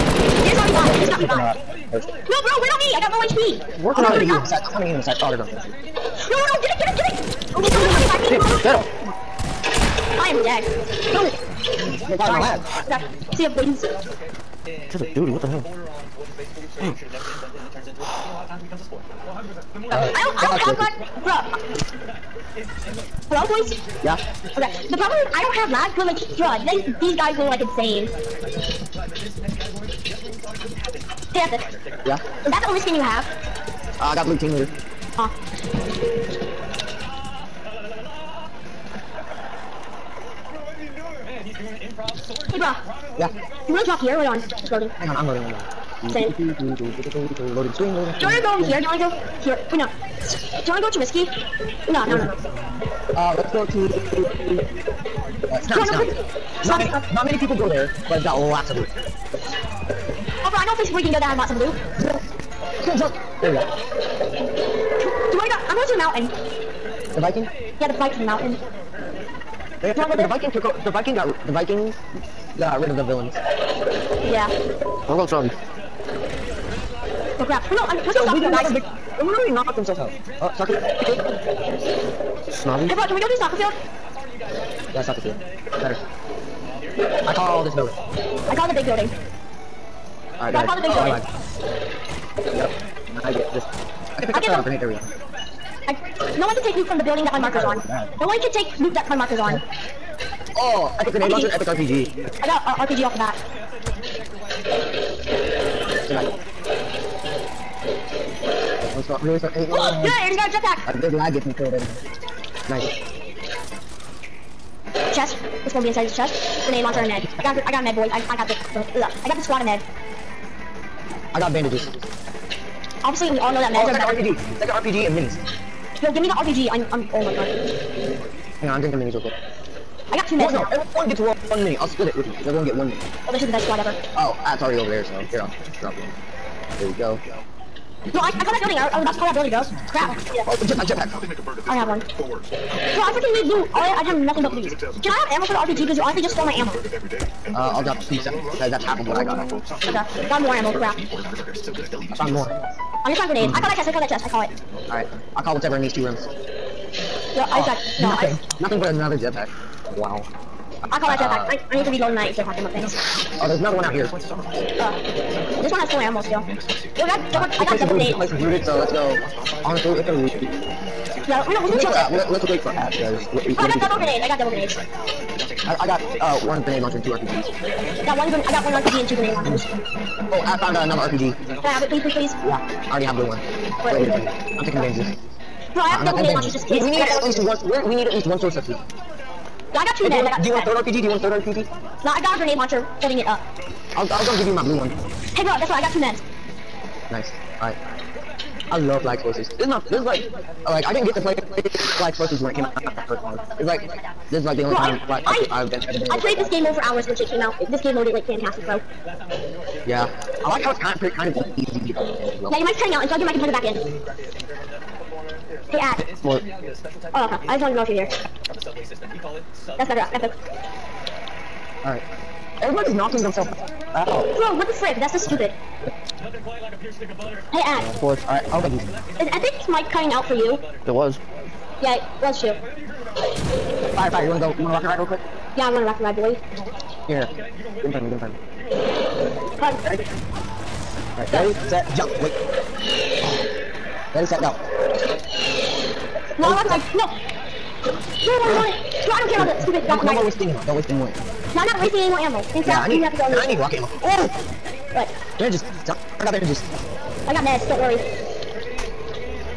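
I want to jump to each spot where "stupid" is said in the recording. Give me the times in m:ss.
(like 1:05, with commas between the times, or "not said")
3:45, 4:09.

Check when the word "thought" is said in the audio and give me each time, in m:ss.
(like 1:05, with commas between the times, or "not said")
1:49.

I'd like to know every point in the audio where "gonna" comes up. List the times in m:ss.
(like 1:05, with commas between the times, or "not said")
1:55, 3:14.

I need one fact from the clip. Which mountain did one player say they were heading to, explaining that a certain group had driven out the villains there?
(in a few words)
Viking Mountain.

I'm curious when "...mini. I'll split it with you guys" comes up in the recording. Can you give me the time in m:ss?
2:11.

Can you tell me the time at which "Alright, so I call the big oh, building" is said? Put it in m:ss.
1:30.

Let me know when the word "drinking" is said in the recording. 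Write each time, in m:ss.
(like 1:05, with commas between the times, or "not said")
2:08.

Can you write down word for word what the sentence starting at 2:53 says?
Uh, what, oh, I got double grenades.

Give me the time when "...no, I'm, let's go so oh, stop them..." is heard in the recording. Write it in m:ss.
1:17.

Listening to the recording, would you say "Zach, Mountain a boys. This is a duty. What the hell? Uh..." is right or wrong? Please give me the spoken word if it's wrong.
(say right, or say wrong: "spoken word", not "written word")
wrong: "See", not "Mountain".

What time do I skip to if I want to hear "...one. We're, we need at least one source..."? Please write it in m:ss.
3:07.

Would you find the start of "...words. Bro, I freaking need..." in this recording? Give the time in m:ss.
2:22.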